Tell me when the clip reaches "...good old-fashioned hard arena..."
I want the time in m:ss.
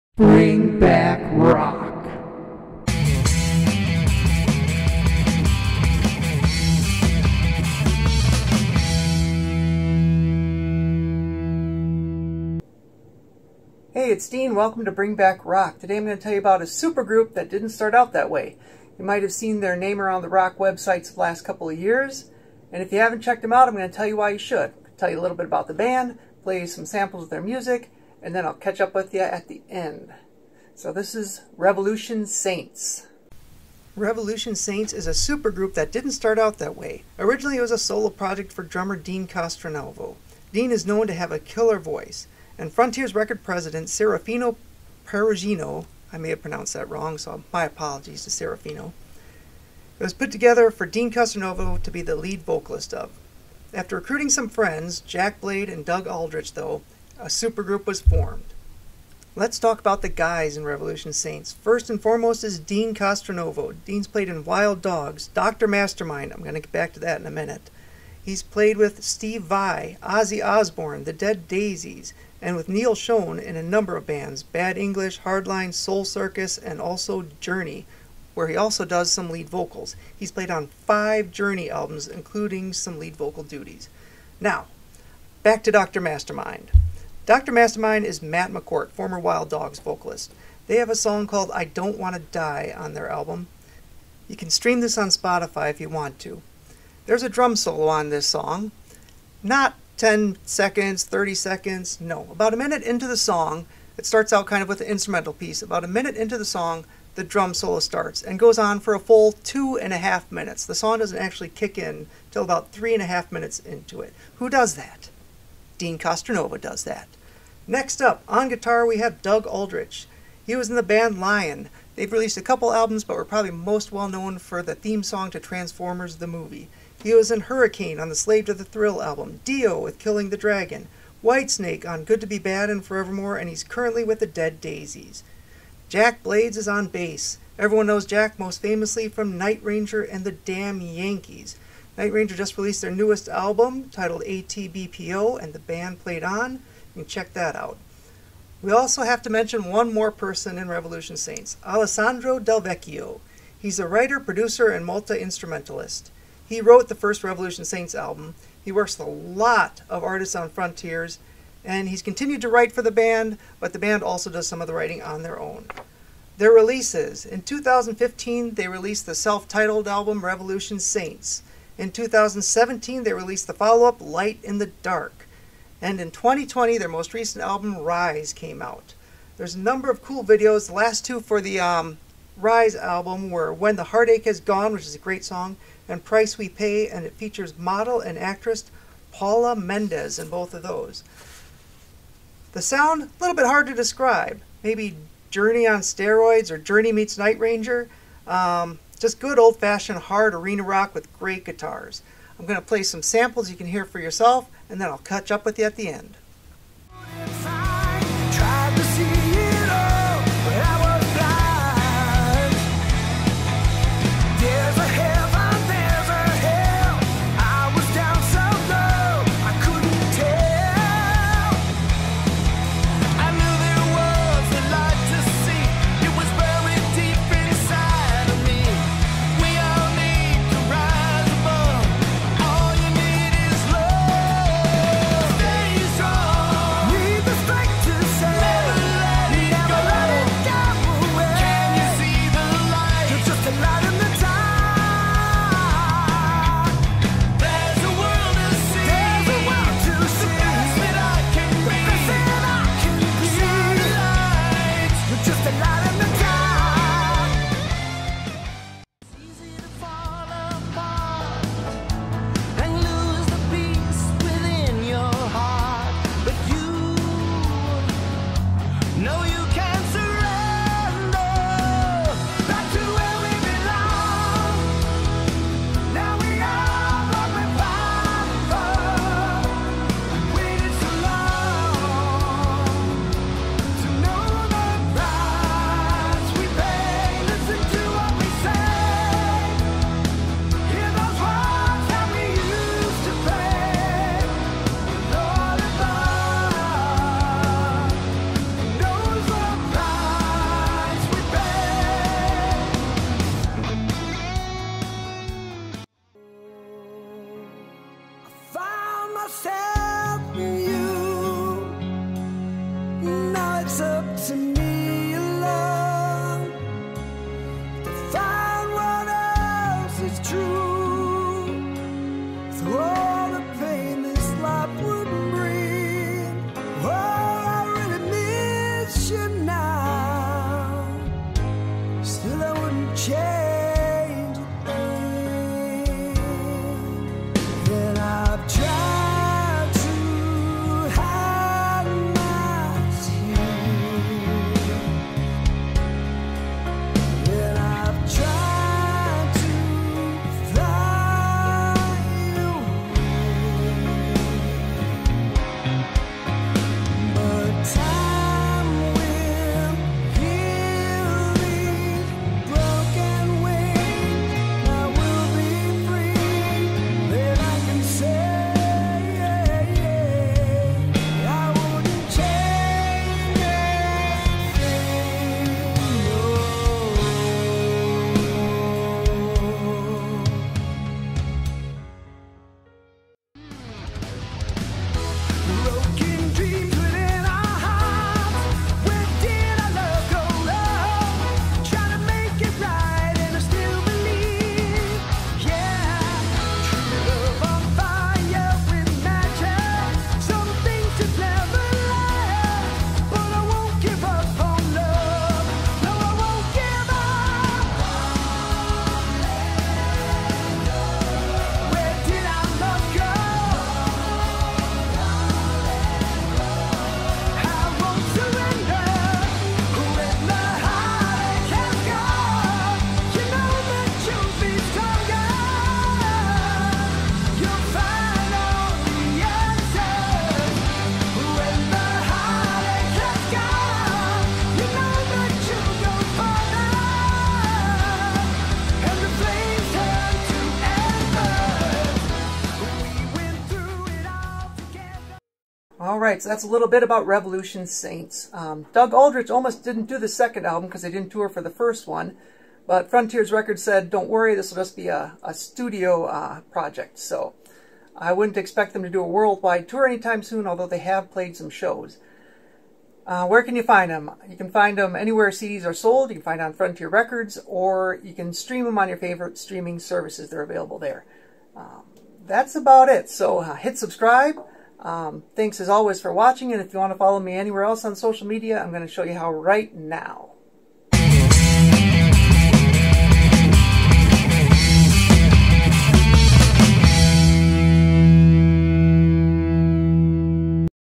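3:19.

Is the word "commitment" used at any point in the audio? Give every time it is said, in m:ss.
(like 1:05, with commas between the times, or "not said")
not said.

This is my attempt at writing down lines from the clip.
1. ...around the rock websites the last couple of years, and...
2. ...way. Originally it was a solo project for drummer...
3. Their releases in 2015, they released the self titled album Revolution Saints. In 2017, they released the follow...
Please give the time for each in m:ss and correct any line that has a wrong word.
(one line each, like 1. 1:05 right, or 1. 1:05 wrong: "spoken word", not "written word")
1. 0:19 right
2. 0:36 right
3. 2:46 right.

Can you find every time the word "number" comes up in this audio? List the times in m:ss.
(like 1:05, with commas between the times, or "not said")
1:13, 2:59.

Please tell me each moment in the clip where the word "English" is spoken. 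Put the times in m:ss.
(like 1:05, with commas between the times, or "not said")
1:14.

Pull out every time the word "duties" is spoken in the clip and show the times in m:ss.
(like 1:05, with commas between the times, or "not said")
1:23.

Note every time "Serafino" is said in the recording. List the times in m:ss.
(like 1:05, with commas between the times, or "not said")
0:43, 0:48.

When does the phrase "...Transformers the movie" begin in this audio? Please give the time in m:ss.
2:05.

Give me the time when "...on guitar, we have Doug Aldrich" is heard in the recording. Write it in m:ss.
1:58.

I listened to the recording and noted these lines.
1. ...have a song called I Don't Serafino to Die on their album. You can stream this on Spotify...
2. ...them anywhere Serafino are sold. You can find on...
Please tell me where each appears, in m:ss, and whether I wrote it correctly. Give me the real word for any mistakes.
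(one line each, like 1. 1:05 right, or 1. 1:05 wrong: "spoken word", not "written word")
1. 1:30 wrong: "Want", not "Serafino"
2. 7:44 wrong: "CDs", not "Serafino".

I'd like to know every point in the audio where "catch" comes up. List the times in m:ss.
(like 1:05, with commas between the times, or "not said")
0:28, 3:24.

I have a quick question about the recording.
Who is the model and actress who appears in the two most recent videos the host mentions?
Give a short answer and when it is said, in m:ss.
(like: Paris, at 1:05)
Paula Mendez, at 3:09.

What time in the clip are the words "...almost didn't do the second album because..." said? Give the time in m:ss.
7:29.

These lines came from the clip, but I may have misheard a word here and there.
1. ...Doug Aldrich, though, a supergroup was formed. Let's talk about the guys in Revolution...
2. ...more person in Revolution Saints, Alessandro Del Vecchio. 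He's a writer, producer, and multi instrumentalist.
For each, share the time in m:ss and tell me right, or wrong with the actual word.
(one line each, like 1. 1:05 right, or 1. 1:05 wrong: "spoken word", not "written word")
1. 0:55 right
2. 2:29 right.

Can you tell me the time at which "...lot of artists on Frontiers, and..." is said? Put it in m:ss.
2:39.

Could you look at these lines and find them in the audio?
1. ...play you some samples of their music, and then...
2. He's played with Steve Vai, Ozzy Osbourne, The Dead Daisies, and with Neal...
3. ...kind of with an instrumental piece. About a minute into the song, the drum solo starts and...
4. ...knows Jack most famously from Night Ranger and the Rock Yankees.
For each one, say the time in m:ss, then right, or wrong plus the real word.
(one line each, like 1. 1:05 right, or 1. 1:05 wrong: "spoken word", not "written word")
1. 0:26 right
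2. 1:08 right
3. 1:44 right
4. 2:17 wrong: "Damn", not "Rock".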